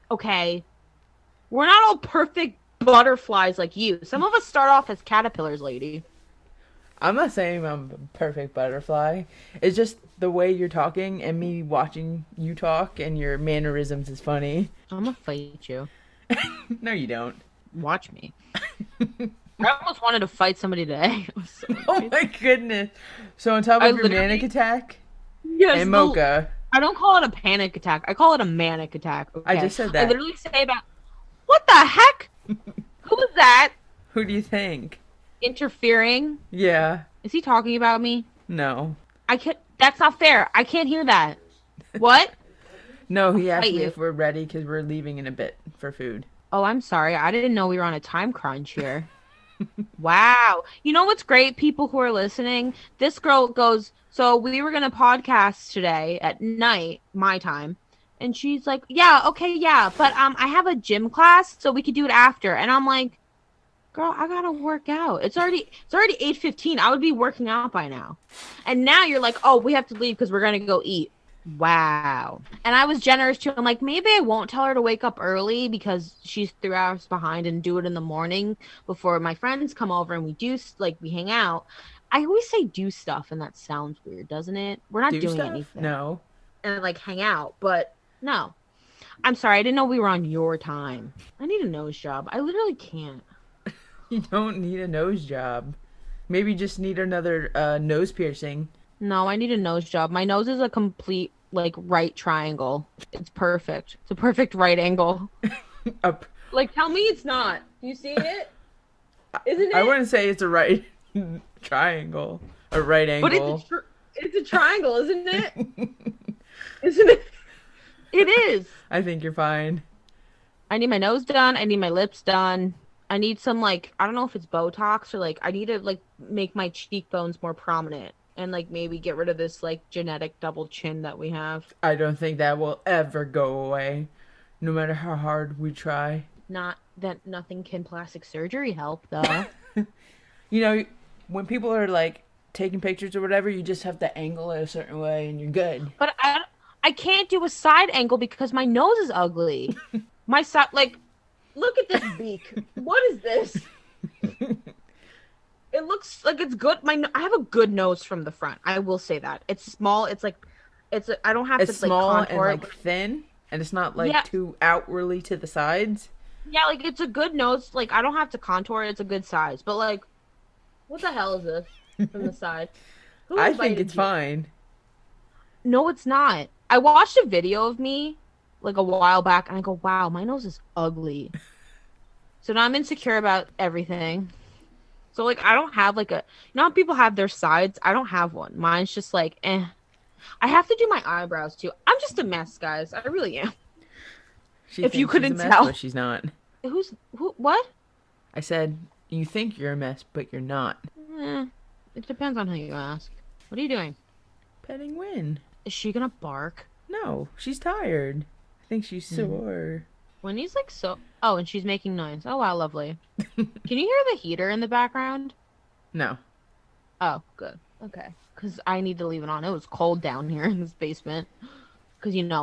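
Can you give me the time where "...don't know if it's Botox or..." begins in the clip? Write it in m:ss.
2:04.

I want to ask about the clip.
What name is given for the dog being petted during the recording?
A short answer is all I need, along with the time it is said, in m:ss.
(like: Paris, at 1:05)
Win, at 3:24.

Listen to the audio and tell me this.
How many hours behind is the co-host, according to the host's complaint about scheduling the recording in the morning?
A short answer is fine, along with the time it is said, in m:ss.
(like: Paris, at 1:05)
3, at 1:16.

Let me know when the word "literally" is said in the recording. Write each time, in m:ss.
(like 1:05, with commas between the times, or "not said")
0:30, 1:32.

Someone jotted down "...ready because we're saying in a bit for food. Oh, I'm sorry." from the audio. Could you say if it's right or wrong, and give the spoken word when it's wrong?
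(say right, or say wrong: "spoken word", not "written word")
wrong: "leaving", not "saying".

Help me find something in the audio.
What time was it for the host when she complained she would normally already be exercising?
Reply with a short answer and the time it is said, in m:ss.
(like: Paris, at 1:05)
8:15, at 1:06.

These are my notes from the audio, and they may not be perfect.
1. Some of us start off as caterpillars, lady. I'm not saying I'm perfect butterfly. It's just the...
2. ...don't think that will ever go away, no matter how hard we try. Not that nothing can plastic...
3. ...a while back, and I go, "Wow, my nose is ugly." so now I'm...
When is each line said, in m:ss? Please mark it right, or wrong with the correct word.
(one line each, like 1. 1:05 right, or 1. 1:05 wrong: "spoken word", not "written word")
1. 0:04 right
2. 2:11 right
3. 2:58 right.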